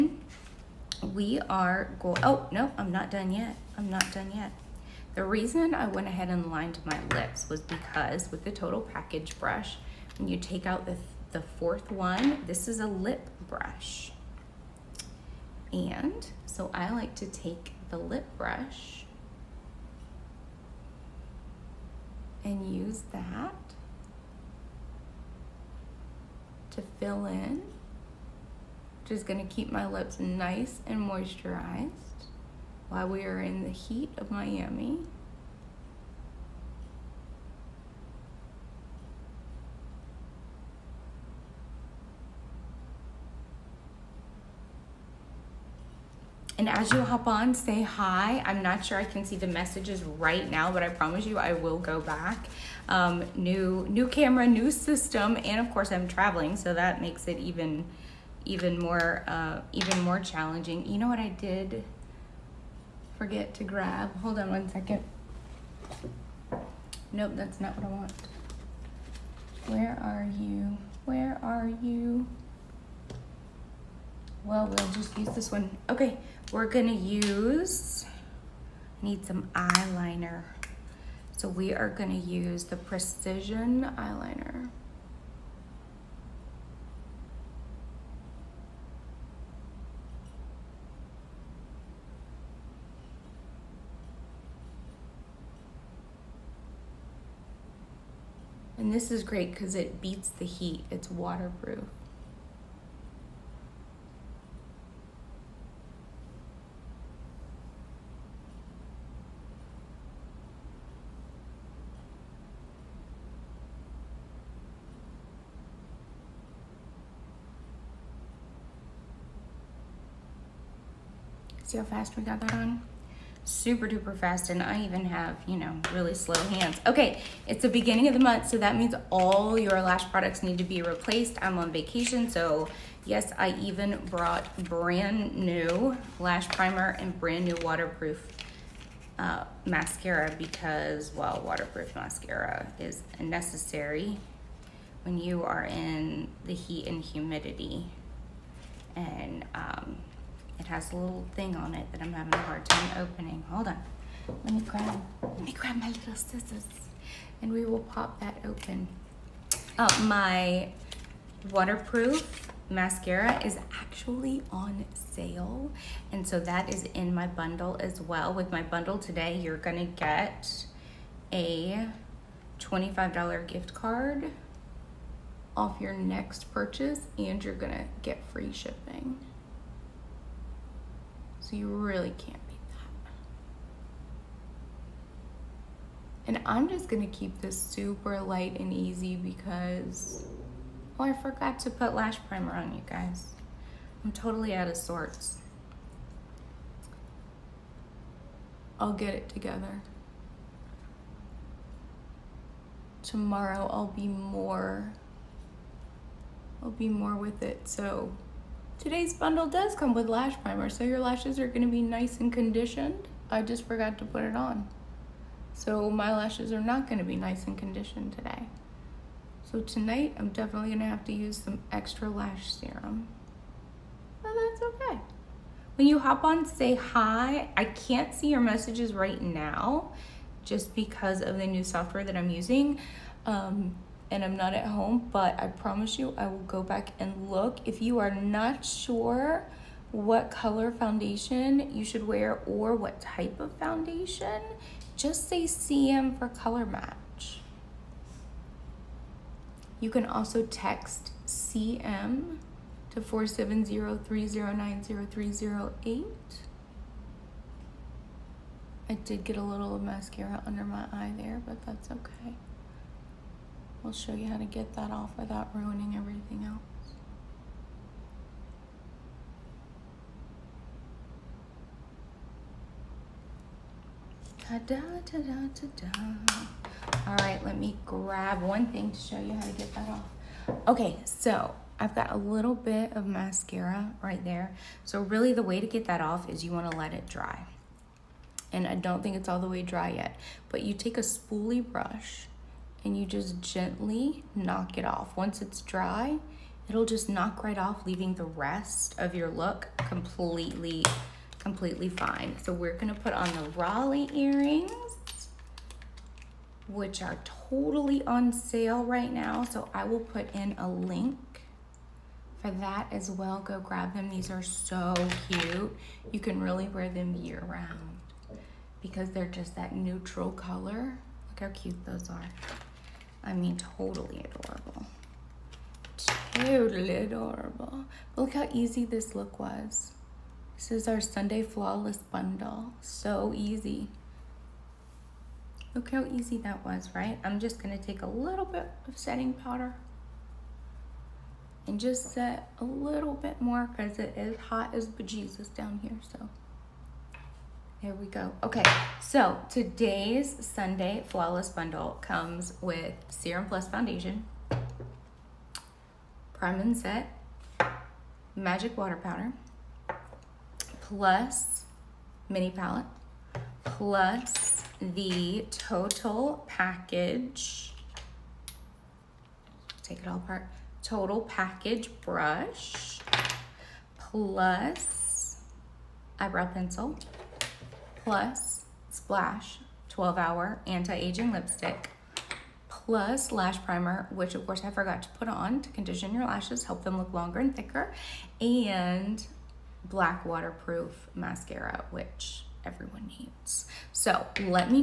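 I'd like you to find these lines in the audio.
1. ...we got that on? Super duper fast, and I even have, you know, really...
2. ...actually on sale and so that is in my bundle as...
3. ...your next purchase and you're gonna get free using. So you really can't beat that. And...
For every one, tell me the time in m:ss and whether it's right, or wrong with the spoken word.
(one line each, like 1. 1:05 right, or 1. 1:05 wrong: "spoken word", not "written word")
1. 2:02 right
2. 2:43 right
3. 2:55 wrong: "shipping", not "using".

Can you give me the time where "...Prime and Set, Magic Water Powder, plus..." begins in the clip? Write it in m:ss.
5:56.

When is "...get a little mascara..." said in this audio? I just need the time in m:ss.
4:19.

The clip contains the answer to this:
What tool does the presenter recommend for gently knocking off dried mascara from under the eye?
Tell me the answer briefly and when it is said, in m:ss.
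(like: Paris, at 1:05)
spoolie brush, at 4:51.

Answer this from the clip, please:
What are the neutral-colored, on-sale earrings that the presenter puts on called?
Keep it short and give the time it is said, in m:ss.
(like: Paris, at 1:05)
Raleigh, at 5:03.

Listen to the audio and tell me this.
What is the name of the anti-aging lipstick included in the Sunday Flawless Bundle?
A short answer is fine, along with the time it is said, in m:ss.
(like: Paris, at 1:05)
Splash 12 Hour, at 6:18.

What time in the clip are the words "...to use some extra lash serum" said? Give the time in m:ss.
3:41.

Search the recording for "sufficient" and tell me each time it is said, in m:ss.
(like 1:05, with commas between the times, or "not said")
not said.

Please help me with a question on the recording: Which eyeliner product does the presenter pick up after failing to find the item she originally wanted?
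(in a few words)
Precision Eyeliner.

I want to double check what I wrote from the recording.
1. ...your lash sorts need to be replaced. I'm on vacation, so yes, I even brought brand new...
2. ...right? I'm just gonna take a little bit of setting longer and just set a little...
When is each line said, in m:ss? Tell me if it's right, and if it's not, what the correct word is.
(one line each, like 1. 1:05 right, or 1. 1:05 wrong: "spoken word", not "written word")
1. 2:09 wrong: "products", not "sorts"
2. 5:36 wrong: "powder", not "longer".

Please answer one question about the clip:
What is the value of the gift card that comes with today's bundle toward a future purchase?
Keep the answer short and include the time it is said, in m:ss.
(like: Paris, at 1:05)
$25, at 2:52.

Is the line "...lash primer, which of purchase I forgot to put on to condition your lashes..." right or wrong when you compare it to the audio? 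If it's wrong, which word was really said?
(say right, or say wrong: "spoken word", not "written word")
wrong: "course", not "purchase".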